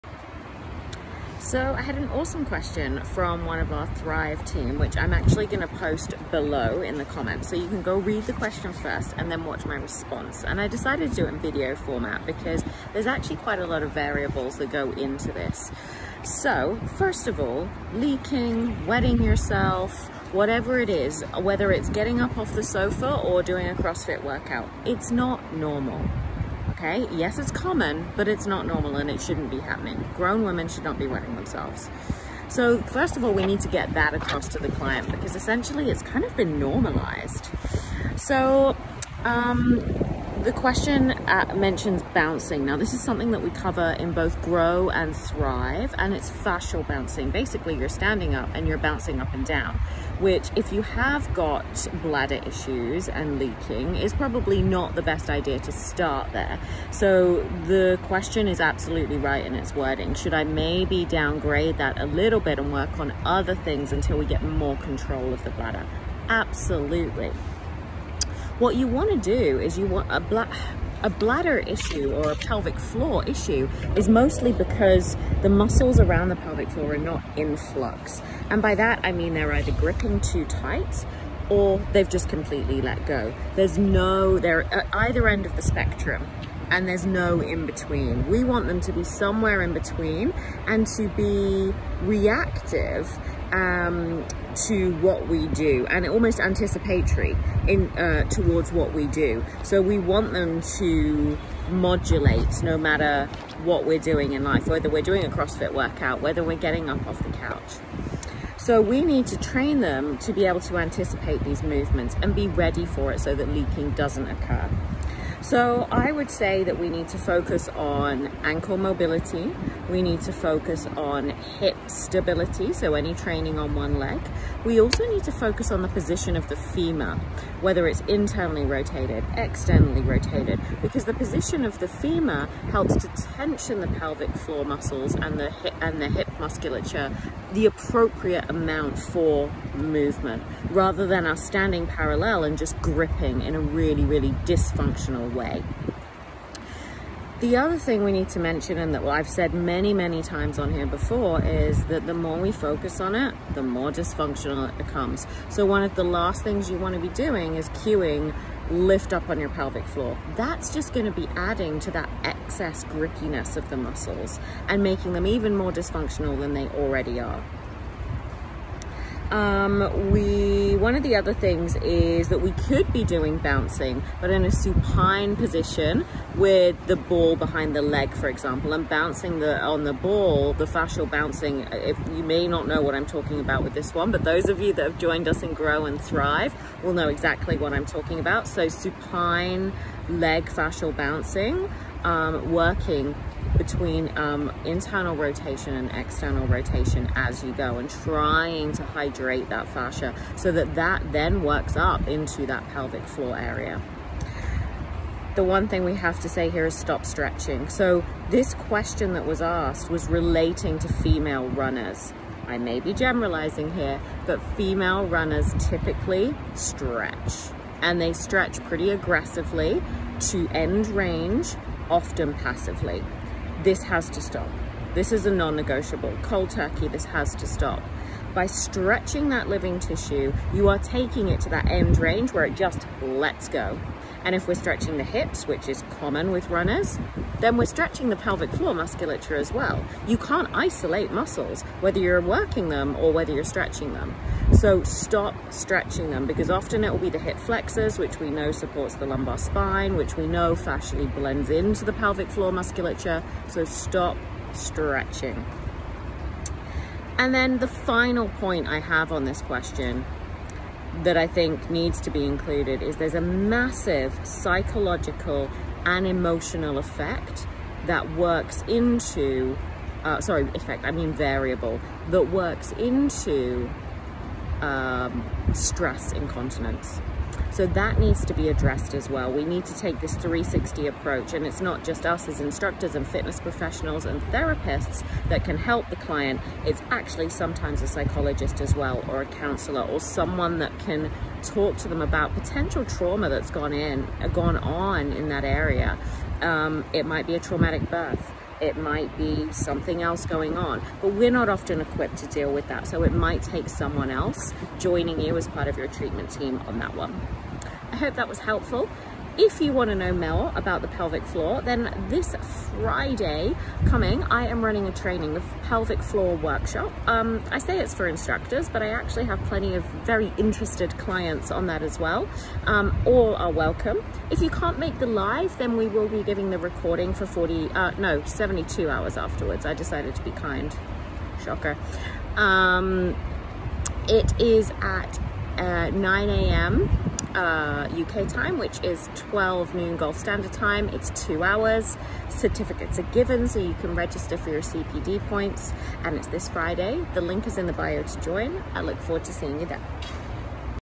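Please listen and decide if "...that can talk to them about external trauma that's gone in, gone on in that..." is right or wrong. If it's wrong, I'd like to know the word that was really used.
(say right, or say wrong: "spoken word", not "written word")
wrong: "potential", not "external".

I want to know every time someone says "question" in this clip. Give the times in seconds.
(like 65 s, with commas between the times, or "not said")
2 s, 8 s, 40 s, 58 s, 208 s, 259 s.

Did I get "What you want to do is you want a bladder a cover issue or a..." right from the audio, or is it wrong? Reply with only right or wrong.
wrong.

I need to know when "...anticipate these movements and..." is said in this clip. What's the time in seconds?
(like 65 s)
110 s.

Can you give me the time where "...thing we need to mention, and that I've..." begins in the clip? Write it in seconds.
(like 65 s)
147 s.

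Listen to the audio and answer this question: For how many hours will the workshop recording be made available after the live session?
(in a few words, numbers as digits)
72.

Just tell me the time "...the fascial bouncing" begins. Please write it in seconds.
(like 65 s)
180 s.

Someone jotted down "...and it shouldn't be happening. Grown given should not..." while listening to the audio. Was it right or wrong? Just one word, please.
wrong.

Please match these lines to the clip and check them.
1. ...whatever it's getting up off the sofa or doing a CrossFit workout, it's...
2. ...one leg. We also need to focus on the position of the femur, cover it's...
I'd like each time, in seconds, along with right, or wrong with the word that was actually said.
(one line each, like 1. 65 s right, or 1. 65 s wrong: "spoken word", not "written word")
1. 21 s wrong: "whether", not "whatever"
2. 123 s wrong: "whether", not "cover".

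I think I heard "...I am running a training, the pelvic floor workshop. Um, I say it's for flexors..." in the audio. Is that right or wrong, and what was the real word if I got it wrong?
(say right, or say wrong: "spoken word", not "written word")
wrong: "instructors", not "flexors".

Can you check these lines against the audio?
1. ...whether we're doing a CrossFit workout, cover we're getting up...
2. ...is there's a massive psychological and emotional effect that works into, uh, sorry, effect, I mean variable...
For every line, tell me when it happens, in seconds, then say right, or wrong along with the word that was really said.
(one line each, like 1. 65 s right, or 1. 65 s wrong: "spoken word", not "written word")
1. 104 s wrong: "whether", not "cover"
2. 262 s right.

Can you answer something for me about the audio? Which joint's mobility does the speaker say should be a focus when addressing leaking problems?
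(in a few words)
ankle.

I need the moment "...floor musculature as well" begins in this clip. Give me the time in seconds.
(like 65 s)
238 s.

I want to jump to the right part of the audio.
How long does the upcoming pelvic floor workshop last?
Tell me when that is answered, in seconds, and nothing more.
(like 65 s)
341 s.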